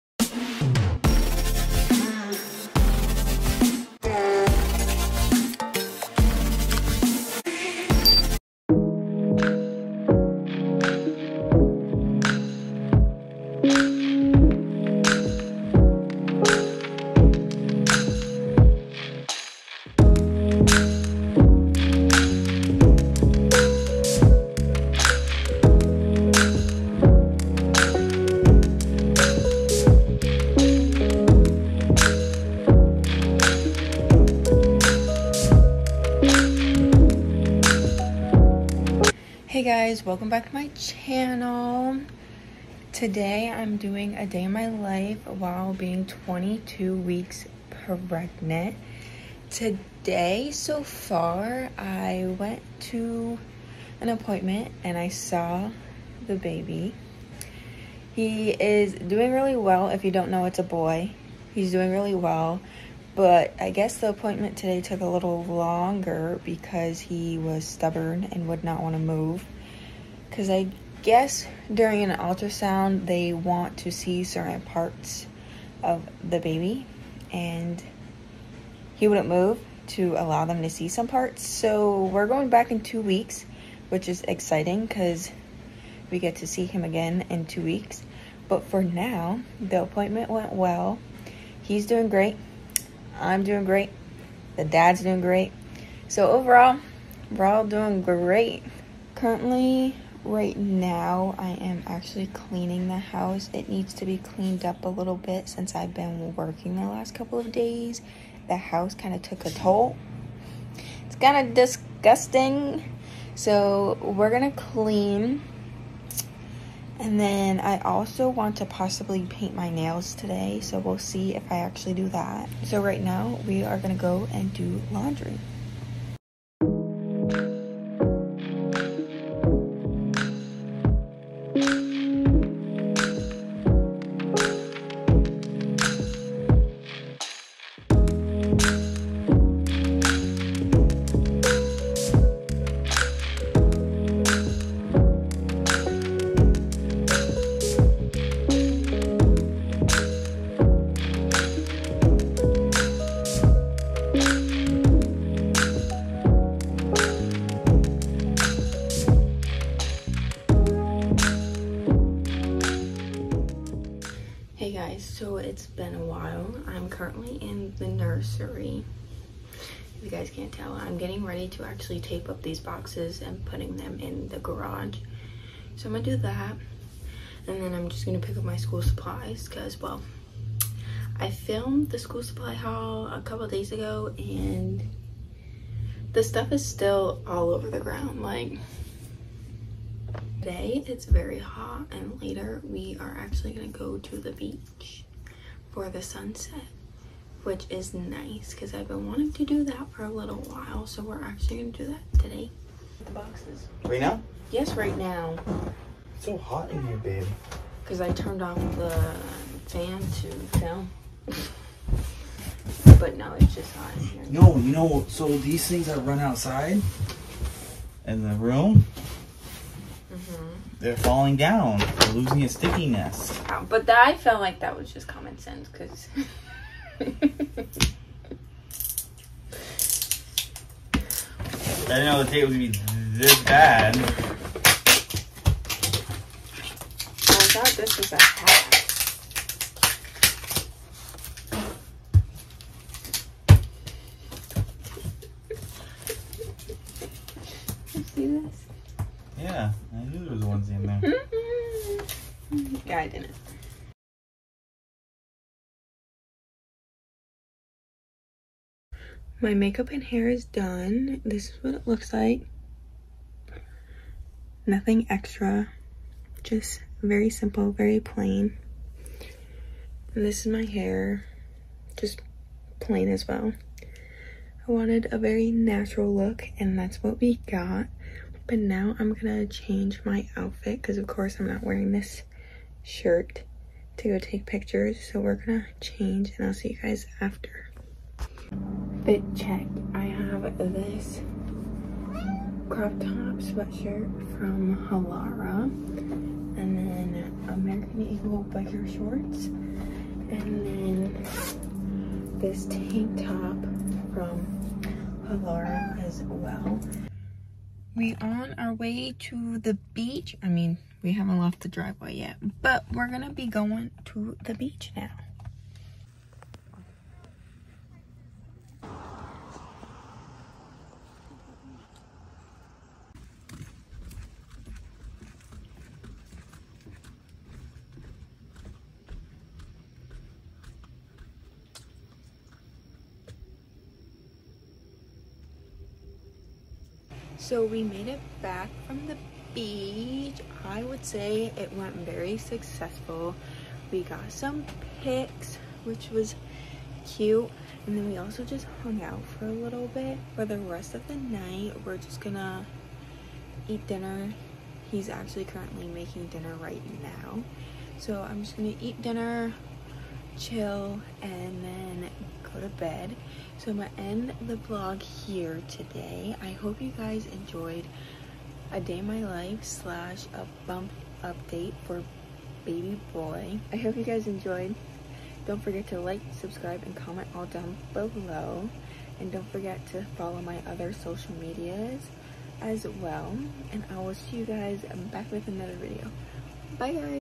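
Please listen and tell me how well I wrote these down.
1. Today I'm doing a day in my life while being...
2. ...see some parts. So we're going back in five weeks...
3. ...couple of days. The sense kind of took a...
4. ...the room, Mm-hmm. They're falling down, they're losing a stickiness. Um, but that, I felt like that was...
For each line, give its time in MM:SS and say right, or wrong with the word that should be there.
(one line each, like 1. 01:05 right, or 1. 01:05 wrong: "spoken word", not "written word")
1. 00:42 right
2. 01:20 wrong: "two", not "five"
3. 01:47 wrong: "house", not "sense"
4. 03:38 right.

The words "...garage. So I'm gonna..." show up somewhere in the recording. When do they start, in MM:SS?
02:54.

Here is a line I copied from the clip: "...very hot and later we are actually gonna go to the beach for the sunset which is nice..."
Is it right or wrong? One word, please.
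right.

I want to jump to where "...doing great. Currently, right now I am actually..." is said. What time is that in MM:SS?
01:37.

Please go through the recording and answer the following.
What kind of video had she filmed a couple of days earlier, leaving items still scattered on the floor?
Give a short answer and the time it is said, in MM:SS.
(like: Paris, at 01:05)
school supply haul, at 03:01.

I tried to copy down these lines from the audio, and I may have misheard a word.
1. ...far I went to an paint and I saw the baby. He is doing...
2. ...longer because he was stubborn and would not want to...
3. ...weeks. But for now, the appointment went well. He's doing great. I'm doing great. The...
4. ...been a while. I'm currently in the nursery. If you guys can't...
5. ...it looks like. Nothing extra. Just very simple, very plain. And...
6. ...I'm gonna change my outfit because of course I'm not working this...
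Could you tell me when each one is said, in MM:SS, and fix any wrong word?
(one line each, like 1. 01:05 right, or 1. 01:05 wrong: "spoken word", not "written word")
1. 00:50 wrong: "appointment", not "paint"
2. 01:05 right
3. 01:27 right
4. 02:45 right
5. 04:21 right
6. 04:38 wrong: "wearing", not "working".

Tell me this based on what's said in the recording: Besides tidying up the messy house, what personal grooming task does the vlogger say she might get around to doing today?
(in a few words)
paint my nails.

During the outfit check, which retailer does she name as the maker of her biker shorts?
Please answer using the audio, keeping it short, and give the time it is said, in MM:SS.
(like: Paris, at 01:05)
American Eagle, at 04:57.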